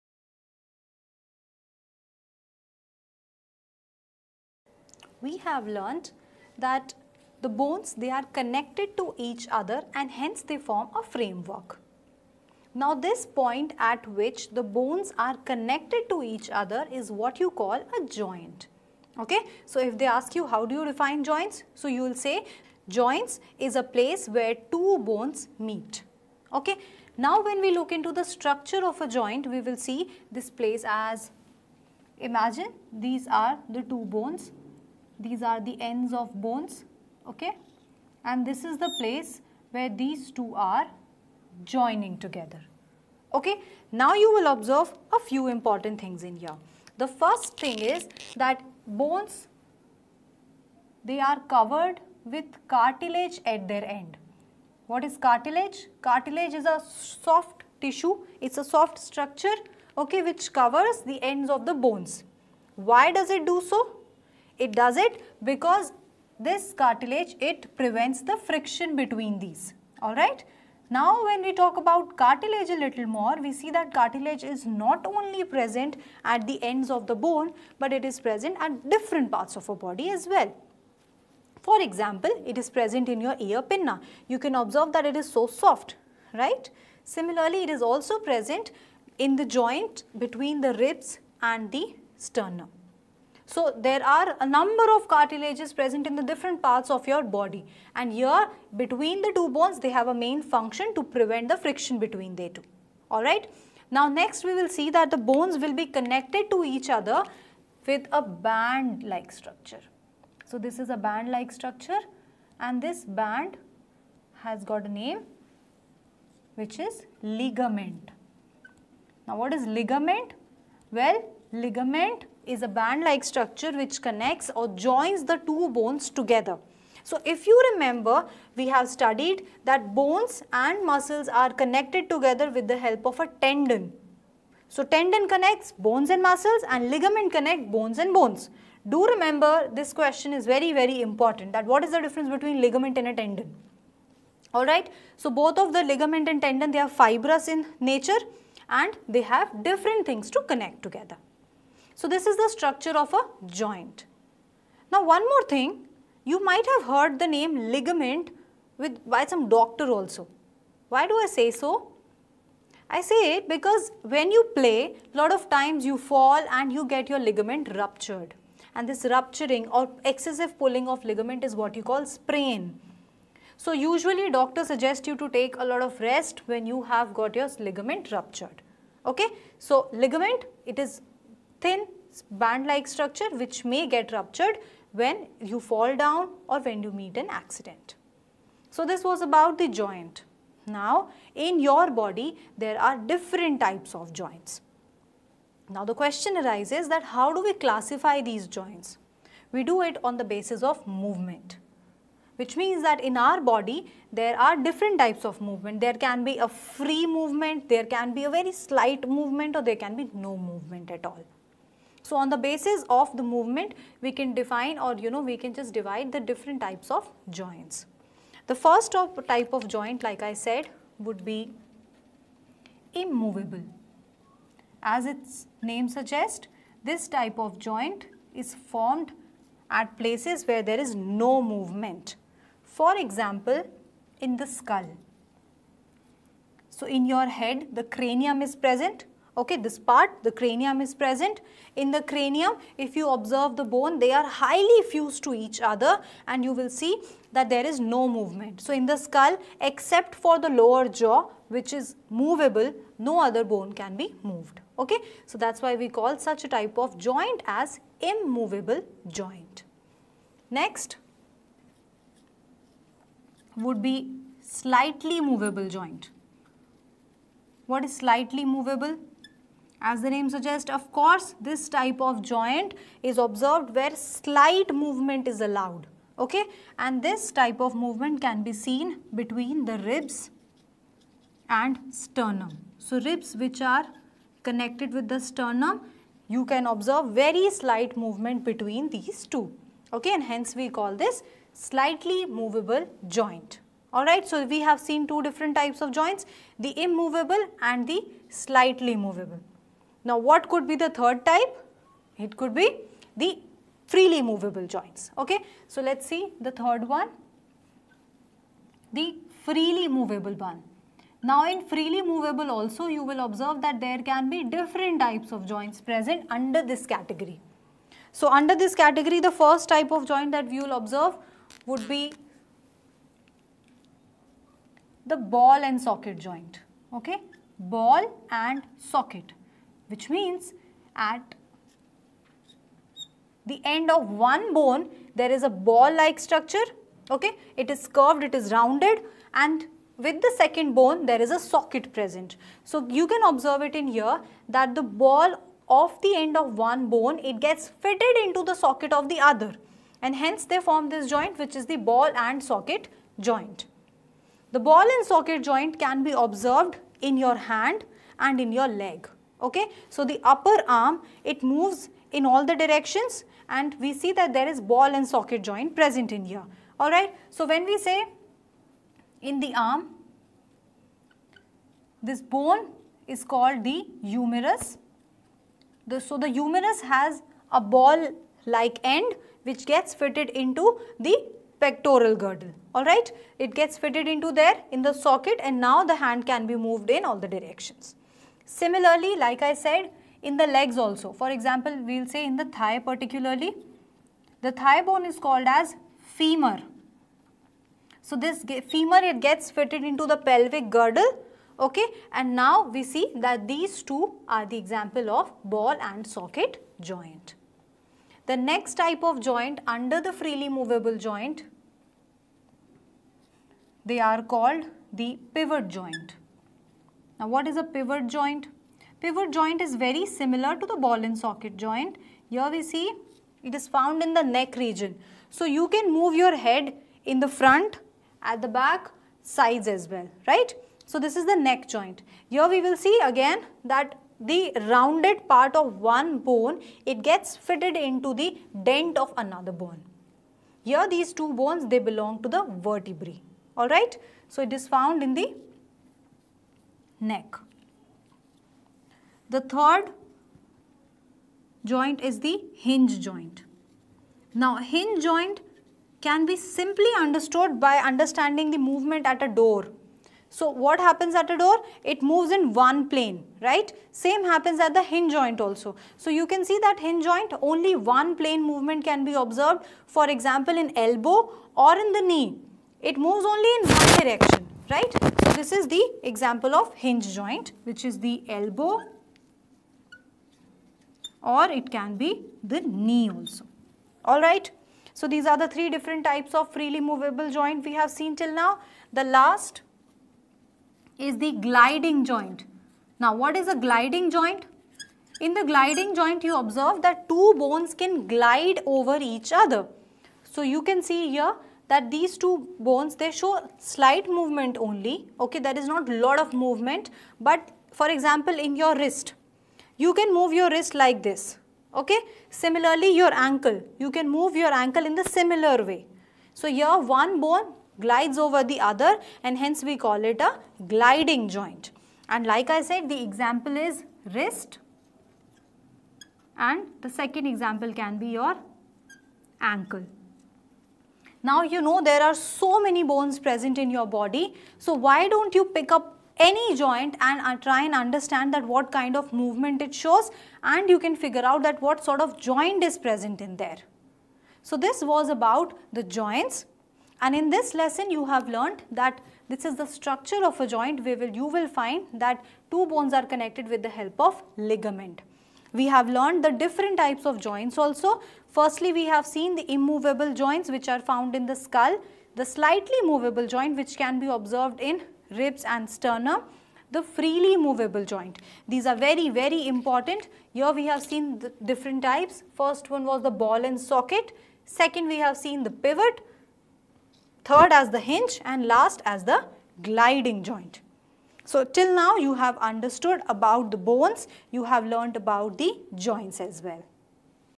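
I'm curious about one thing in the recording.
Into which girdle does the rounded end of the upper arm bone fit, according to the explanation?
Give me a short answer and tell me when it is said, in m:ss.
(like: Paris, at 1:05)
Pectoral girdle, at 6:21.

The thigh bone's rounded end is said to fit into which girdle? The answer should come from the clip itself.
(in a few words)
Pelvic girdle.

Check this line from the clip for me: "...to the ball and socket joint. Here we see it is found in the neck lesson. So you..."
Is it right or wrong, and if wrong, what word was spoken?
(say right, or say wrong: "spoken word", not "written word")
wrong: "region", not "lesson".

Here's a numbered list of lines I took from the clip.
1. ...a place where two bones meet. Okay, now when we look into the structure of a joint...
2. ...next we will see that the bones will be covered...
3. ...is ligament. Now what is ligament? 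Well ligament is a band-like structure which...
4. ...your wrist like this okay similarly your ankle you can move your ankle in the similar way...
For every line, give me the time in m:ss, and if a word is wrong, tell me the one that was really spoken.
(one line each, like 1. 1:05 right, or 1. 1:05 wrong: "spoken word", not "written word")
1. 0:23 right
2. 1:44 wrong: "connected", not "covered"
3. 1:56 right
4. 8:30 right.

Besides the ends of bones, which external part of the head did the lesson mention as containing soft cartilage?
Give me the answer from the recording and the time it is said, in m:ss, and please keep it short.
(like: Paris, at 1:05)
Ear pinna, at 1:23.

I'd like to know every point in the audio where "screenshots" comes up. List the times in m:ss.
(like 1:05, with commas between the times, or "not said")
not said.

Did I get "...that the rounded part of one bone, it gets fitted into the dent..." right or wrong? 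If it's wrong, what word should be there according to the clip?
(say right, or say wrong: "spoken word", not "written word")
right.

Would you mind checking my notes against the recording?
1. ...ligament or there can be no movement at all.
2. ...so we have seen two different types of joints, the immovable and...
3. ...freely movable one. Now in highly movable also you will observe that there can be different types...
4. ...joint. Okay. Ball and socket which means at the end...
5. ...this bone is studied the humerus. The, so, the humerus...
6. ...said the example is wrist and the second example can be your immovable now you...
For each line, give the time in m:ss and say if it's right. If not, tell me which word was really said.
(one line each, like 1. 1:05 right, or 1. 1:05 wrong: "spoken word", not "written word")
1. 3:29 wrong: "movement", not "ligament"
2. 4:54 right
3. 5:09 wrong: "freely", not "highly"
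4. 5:26 right
5. 6:12 wrong: "called", not "studied"
6. 8:42 wrong: "ankle", not "immovable".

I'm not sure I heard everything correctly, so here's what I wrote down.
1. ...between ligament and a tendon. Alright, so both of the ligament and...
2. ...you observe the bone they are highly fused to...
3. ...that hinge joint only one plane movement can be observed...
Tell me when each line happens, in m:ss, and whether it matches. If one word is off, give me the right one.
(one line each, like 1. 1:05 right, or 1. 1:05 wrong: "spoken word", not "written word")
1. 2:22 right
2. 4:02 right
3. 7:46 right.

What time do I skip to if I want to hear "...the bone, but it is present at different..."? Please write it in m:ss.
1:17.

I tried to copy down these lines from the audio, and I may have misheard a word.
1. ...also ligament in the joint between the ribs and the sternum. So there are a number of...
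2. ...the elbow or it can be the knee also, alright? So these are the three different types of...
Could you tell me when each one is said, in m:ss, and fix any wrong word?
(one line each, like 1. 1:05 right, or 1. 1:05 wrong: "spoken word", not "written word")
1. 1:27 wrong: "present", not "ligament"
2. 7:57 right.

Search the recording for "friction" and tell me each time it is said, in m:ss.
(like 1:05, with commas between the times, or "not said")
1:08, 1:41.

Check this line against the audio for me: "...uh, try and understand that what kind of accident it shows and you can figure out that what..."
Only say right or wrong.
wrong.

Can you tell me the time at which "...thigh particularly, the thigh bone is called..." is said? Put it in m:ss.
6:32.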